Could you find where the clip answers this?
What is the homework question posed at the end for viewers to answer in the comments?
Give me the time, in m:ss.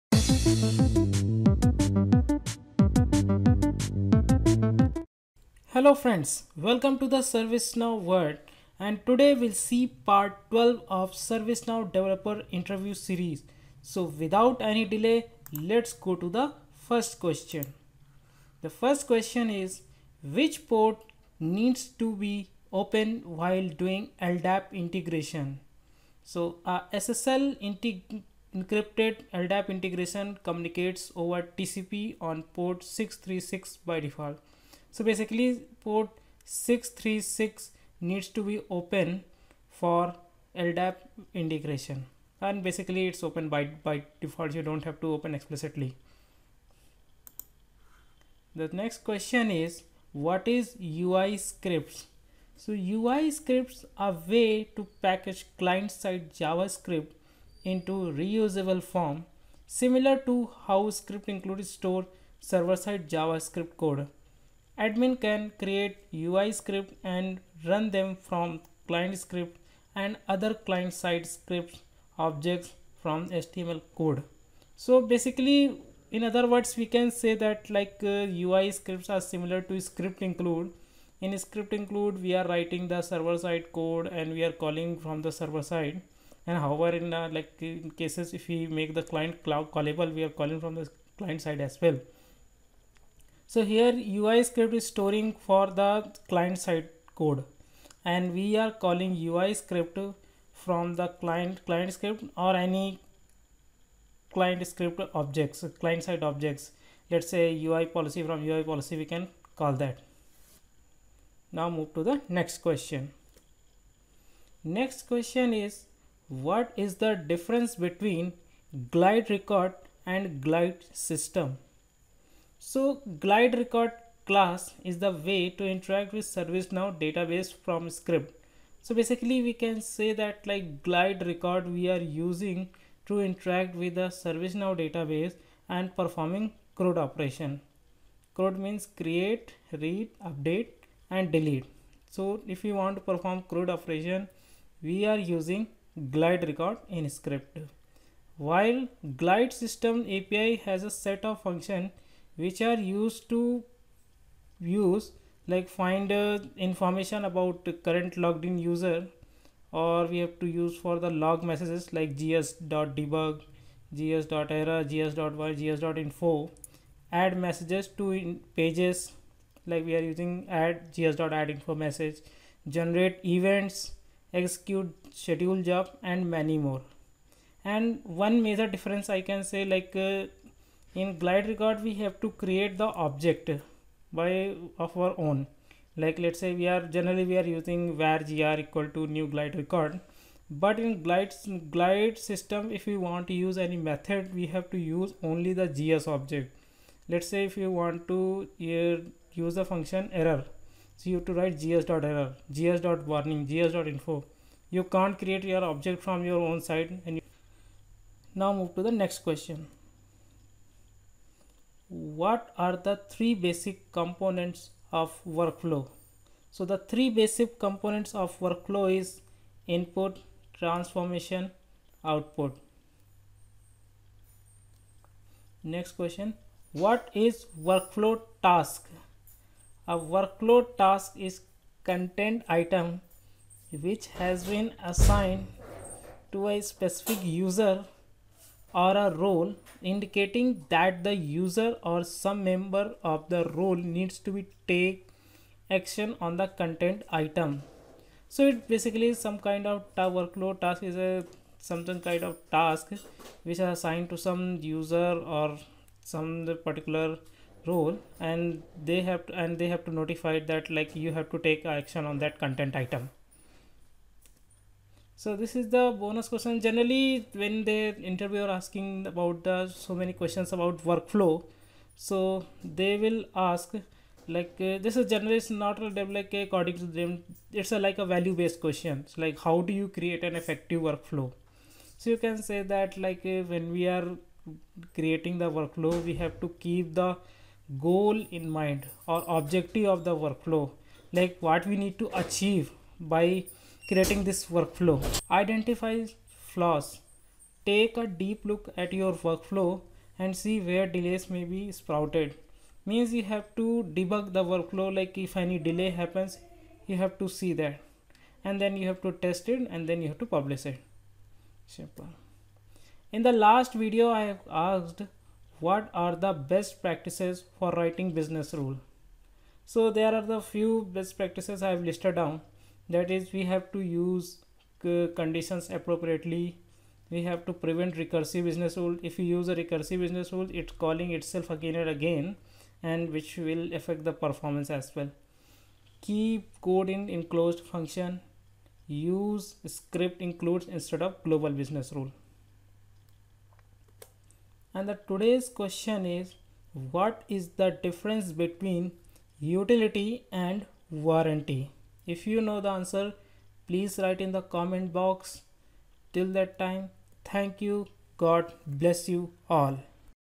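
5:47.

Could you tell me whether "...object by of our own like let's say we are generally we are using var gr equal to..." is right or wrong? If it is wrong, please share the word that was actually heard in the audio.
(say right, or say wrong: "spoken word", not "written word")
right.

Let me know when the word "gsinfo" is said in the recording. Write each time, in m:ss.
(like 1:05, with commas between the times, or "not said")
2:45, 3:23.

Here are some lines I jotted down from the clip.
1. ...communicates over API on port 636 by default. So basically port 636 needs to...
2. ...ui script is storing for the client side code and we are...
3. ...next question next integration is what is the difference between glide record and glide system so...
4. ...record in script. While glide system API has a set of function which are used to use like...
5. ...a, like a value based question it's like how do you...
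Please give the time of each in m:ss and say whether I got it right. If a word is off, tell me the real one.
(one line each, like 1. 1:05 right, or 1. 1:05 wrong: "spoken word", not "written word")
1. 0:30 wrong: "TCP", not "API"
2. 1:34 right
3. 1:52 wrong: "question", not "integration"
4. 2:26 right
5. 4:37 right.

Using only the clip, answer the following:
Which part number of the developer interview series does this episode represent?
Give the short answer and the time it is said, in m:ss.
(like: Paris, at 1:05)
12, at 0:09.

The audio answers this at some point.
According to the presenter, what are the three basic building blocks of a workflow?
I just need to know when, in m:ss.
3:39.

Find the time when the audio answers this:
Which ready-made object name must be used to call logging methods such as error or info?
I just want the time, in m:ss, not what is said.
3:15.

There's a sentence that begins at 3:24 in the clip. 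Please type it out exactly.
You can't create your object from your own side.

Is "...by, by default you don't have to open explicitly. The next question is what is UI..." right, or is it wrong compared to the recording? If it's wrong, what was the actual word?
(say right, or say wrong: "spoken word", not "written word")
right.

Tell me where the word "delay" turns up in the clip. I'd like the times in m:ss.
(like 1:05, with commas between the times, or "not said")
0:14, 5:00, 5:05.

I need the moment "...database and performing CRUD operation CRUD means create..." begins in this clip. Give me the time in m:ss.
2:14.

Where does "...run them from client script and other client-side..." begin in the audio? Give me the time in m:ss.
1:07.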